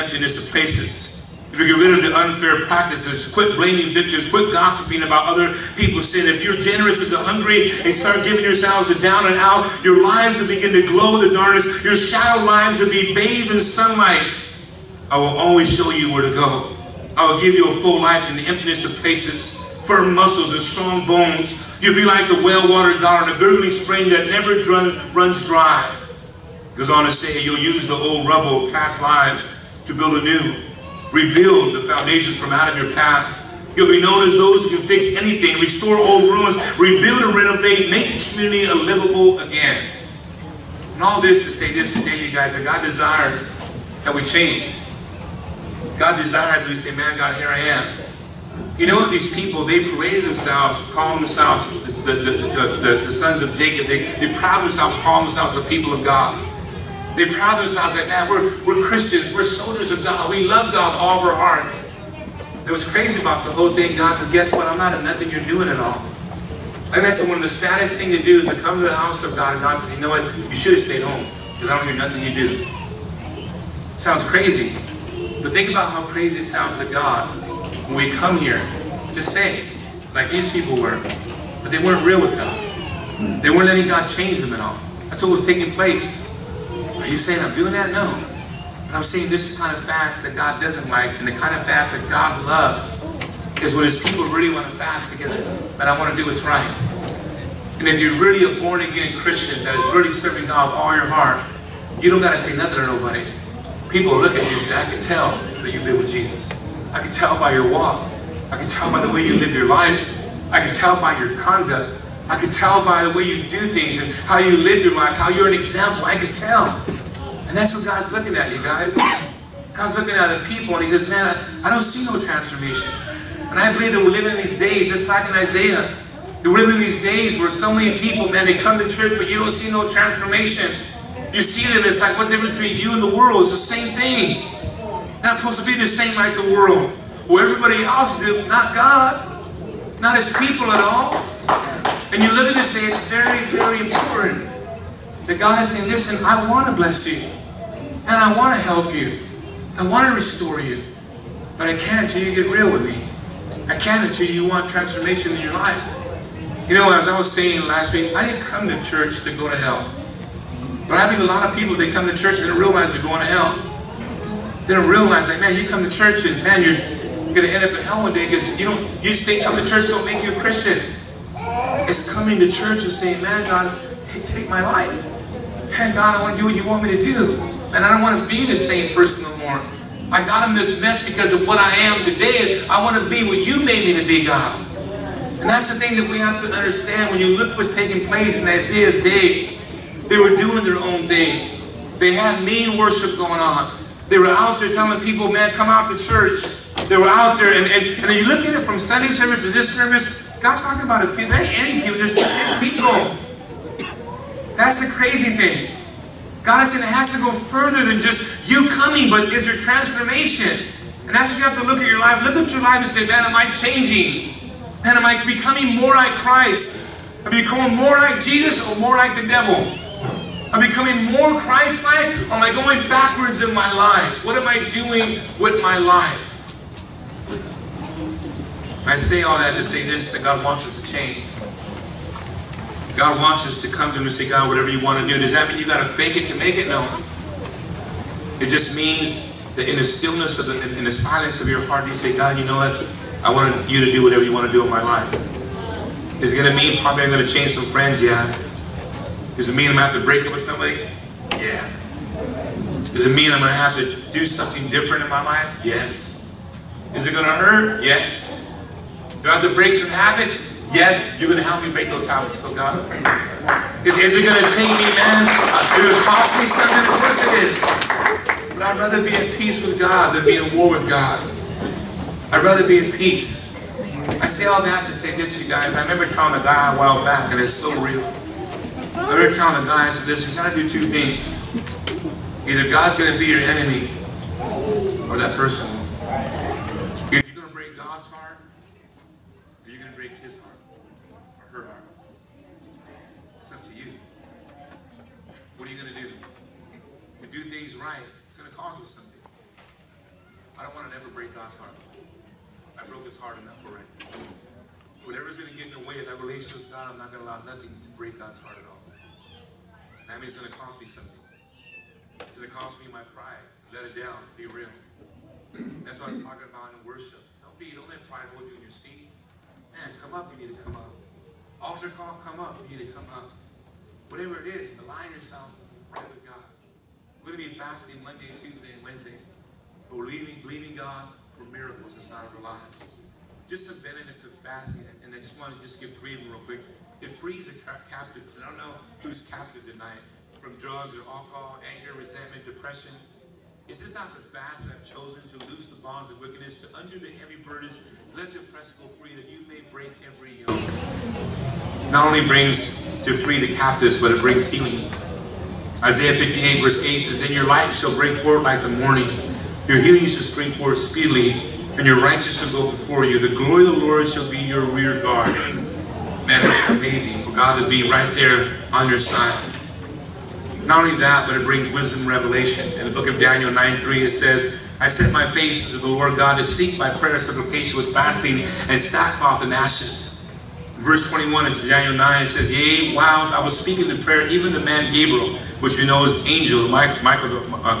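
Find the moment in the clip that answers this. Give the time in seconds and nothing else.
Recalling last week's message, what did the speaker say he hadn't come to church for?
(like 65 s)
159 s.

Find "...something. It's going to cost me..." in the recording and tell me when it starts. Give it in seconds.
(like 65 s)
310 s.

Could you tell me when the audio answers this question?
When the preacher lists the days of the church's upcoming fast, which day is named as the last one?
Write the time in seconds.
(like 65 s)
328 s.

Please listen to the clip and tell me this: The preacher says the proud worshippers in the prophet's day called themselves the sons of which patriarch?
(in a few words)
Jacob.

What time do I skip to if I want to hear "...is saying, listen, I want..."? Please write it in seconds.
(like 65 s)
145 s.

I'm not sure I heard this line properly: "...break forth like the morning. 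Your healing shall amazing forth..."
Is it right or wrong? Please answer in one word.
wrong.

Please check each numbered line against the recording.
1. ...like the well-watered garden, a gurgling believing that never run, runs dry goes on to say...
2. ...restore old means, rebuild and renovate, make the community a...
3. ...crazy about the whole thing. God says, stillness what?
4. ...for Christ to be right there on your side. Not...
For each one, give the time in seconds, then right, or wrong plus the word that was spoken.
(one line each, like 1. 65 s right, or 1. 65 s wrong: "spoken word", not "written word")
1. 22 s wrong: "spring", not "believing"
2. 35 s wrong: "ruins", not "means"
3. 62 s wrong: "guess", not "stillness"
4. 367 s wrong: "God", not "Christ".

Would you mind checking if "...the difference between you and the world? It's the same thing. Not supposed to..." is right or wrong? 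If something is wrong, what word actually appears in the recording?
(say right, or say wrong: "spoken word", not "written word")
right.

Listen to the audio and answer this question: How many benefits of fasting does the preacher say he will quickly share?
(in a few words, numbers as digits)
3.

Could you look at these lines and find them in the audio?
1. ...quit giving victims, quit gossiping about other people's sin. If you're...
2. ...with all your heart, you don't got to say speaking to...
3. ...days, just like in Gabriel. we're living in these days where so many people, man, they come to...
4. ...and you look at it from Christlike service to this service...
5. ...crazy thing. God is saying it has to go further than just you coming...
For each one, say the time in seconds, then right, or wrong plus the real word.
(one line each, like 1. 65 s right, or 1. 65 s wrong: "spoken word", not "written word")
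1. 3 s wrong: "blaming", not "giving"
2. 100 s wrong: "nothing", not "speaking"
3. 124 s wrong: "Isaiah", not "Gabriel"
4. 198 s wrong: "Sunday", not "Christlike"
5. 204 s right.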